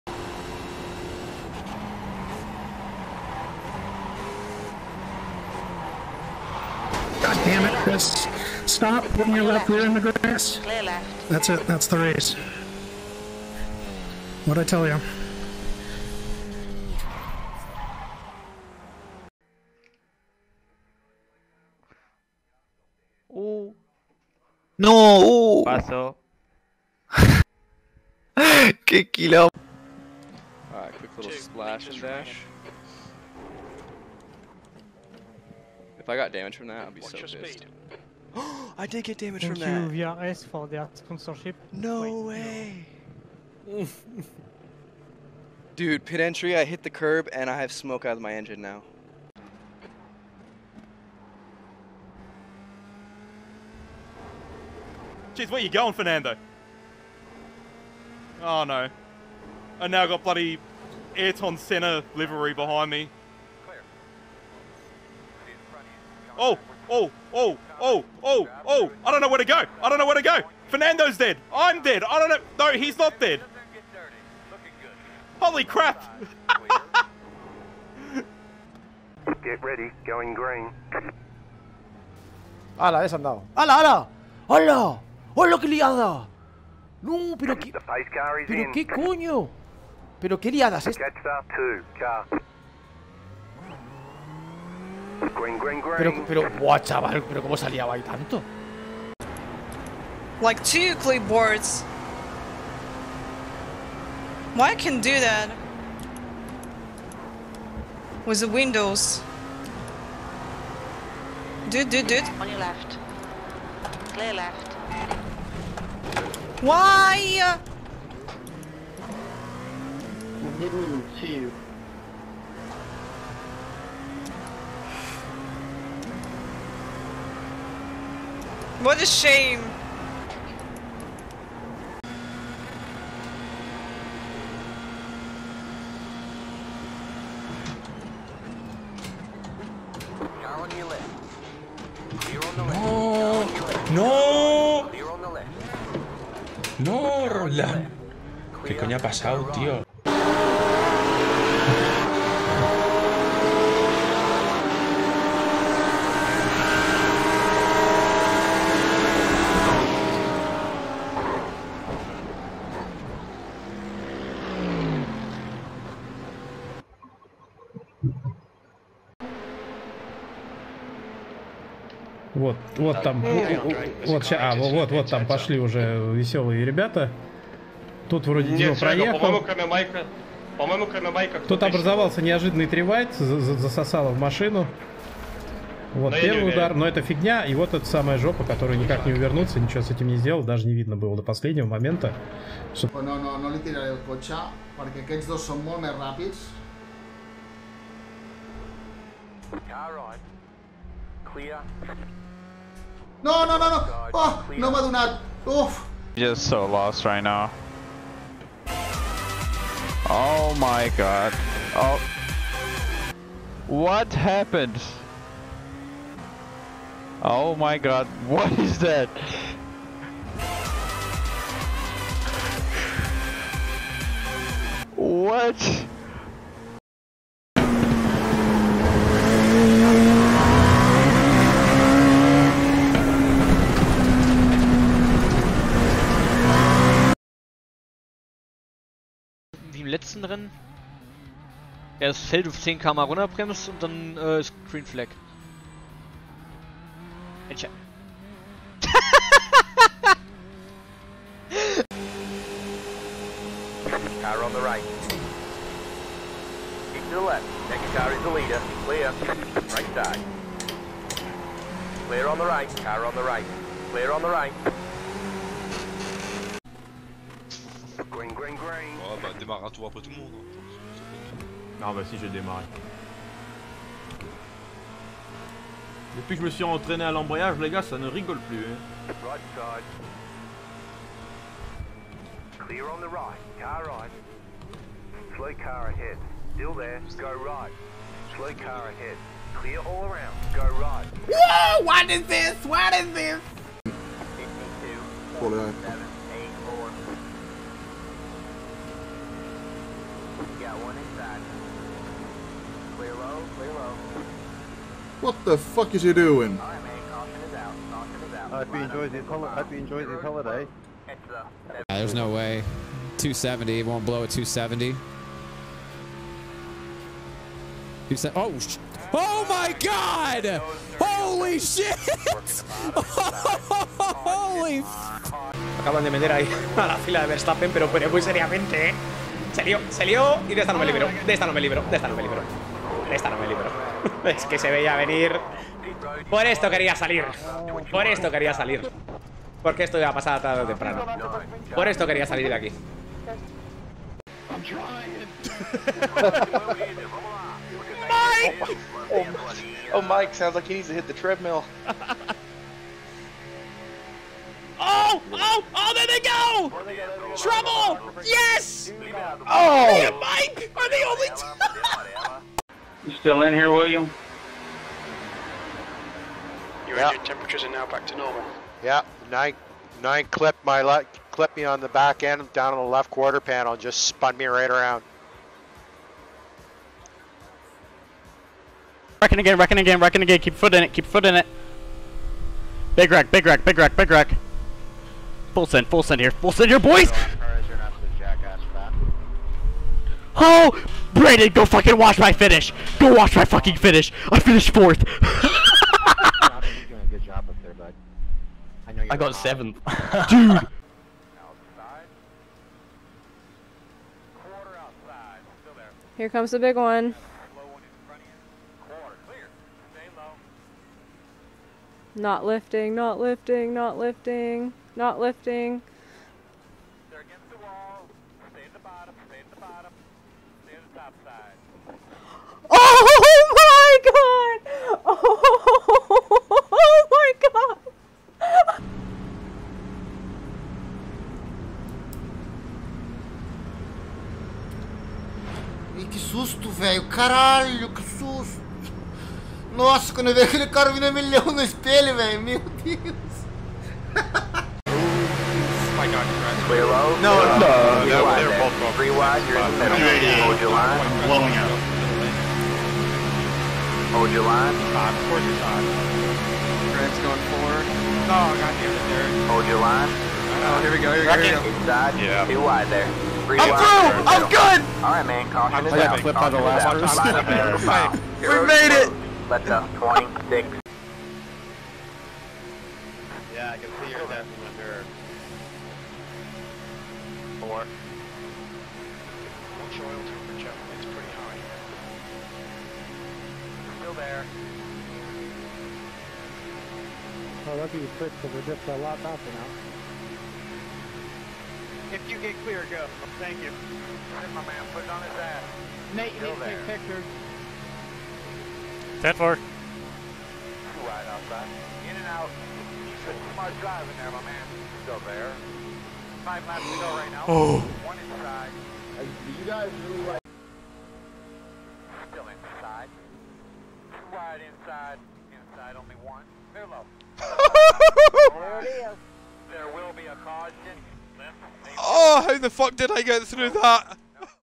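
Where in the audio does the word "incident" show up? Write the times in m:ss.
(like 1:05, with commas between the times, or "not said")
not said.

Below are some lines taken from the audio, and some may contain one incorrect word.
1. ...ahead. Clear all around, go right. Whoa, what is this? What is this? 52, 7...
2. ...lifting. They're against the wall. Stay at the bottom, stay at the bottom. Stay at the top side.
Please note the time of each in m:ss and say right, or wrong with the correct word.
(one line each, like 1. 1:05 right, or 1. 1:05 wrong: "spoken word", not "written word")
1. 4:48 right
2. 6:55 right.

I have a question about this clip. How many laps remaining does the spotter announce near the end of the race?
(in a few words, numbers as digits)
5.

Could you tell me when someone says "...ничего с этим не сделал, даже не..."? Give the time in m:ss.
3:09.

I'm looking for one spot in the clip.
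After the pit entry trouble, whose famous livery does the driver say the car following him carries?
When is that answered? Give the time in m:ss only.
1:01.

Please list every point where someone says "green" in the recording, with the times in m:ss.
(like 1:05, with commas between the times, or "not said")
1:20, 4:04.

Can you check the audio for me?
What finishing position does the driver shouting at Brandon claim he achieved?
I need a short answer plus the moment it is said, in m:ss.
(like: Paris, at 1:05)
Fourth, at 6:34.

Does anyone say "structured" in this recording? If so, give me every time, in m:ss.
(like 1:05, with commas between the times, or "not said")
not said.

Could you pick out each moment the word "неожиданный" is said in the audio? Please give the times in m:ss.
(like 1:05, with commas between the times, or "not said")
3:02.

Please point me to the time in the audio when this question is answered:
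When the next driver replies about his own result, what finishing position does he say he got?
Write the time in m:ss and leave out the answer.
6:39.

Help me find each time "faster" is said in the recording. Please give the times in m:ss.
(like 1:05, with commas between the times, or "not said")
8:09.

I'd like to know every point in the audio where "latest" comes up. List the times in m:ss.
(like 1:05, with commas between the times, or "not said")
not said.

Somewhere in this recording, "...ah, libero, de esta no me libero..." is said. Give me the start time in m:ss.
5:30.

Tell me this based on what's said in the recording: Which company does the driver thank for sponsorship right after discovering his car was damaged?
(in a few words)
VRS.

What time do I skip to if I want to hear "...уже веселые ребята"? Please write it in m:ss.
2:55.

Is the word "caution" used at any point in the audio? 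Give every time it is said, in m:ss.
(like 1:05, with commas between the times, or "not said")
7:45, 8:40.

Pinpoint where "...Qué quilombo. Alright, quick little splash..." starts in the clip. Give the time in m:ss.
0:28.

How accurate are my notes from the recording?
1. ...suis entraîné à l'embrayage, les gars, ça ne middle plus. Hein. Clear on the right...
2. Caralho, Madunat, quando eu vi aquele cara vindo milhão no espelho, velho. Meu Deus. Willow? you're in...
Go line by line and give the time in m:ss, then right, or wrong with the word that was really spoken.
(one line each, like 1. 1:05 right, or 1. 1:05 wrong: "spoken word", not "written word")
1. 4:36 wrong: "rigole", not "middle"
2. 7:17 wrong: "Nossa", not "Madunat".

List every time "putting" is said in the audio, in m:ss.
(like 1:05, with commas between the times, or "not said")
0:09, 8:14.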